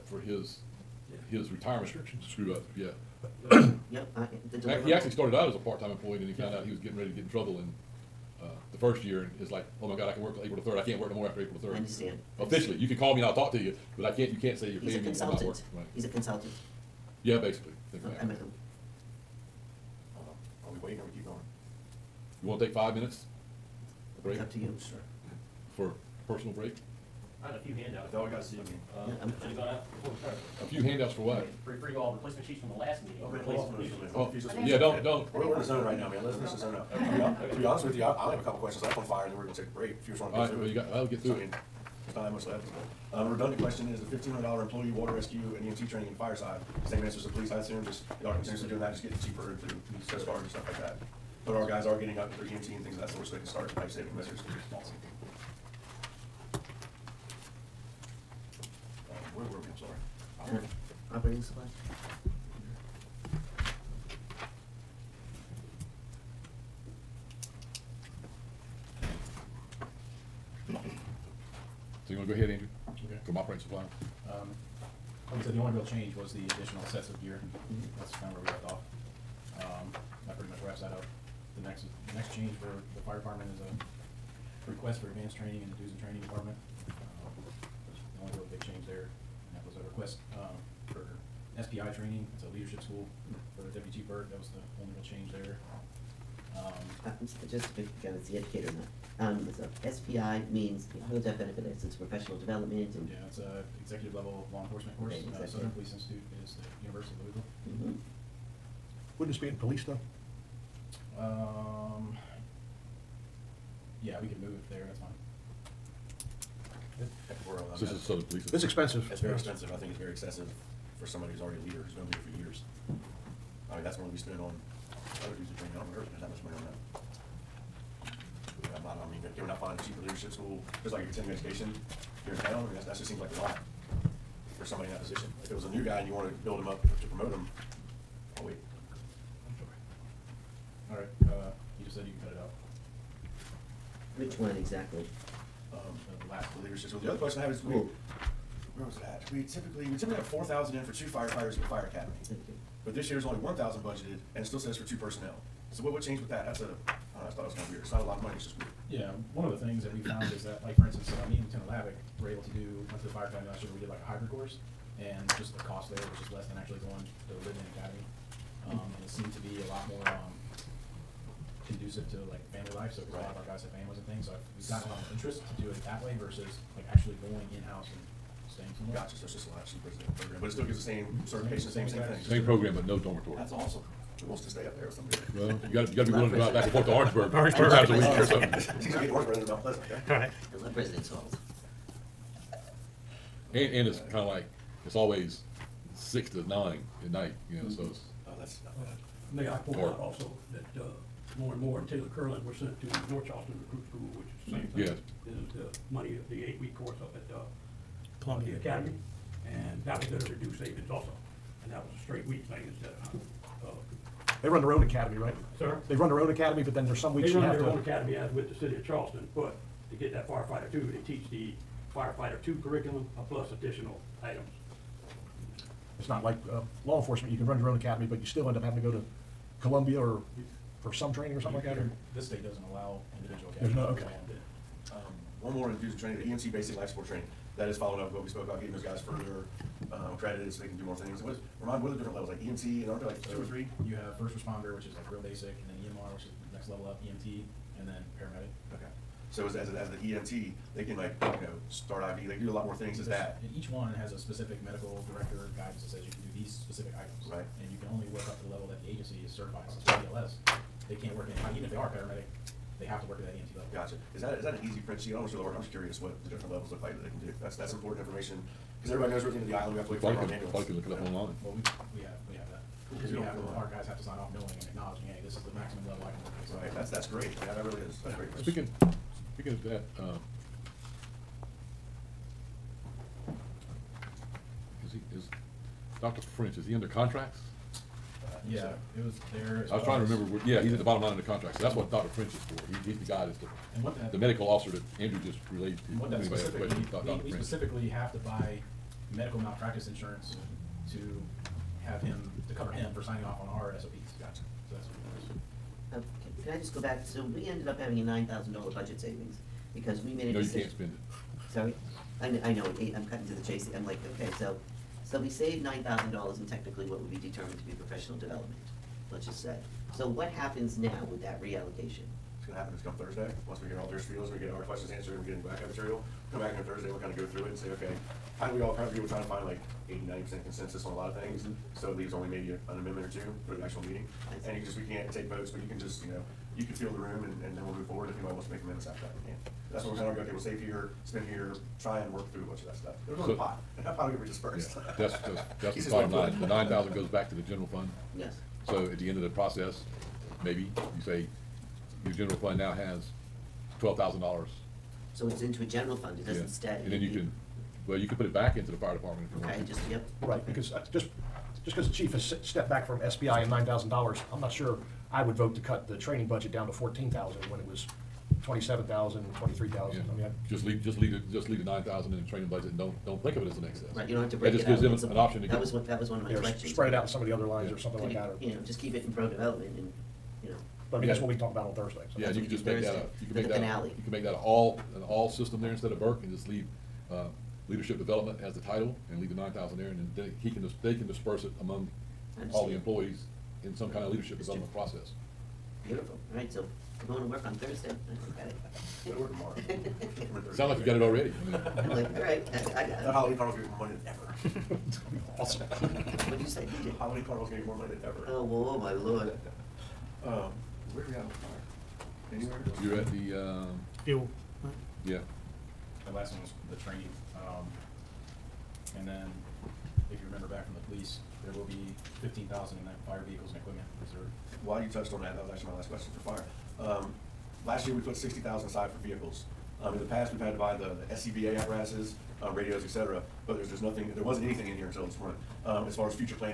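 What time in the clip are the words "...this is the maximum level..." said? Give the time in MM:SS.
04:35.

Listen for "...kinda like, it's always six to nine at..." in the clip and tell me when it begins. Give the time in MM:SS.
03:14.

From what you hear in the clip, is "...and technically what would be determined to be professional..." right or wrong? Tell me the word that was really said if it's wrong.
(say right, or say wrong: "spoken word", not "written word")
right.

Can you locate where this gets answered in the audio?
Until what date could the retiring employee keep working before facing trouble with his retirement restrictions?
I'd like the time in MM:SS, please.
00:10.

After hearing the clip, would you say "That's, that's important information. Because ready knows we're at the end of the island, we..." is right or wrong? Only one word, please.
wrong.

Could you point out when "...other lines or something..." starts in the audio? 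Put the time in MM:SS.
06:17.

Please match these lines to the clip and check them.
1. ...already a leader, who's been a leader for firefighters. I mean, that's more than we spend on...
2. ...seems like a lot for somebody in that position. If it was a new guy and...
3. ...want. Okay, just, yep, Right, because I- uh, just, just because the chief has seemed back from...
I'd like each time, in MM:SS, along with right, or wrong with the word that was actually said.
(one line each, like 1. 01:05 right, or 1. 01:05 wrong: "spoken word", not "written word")
1. 02:01 wrong: "years", not "firefighters"
2. 02:13 right
3. 05:59 wrong: "stepped", not "seemed".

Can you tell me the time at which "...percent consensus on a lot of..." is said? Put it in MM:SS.
05:30.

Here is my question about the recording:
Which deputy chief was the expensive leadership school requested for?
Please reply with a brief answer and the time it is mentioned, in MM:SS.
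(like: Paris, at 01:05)
Deputy Chief Burke, at 01:33.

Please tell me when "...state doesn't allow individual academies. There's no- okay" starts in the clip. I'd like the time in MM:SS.
03:52.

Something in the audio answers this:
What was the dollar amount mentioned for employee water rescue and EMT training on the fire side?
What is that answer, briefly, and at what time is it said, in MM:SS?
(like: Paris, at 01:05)
$1,500, at 00:44.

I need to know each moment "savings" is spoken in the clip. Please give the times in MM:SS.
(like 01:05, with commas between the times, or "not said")
00:53, 03:30, 05:08.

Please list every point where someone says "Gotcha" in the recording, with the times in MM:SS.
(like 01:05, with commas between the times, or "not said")
02:58, 04:23, 05:04.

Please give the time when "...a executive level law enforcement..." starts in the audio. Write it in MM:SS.
01:43.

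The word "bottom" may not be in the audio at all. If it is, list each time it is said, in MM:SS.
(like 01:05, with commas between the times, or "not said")
04:50, 05:45.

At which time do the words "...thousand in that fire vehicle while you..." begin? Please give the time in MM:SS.
07:02.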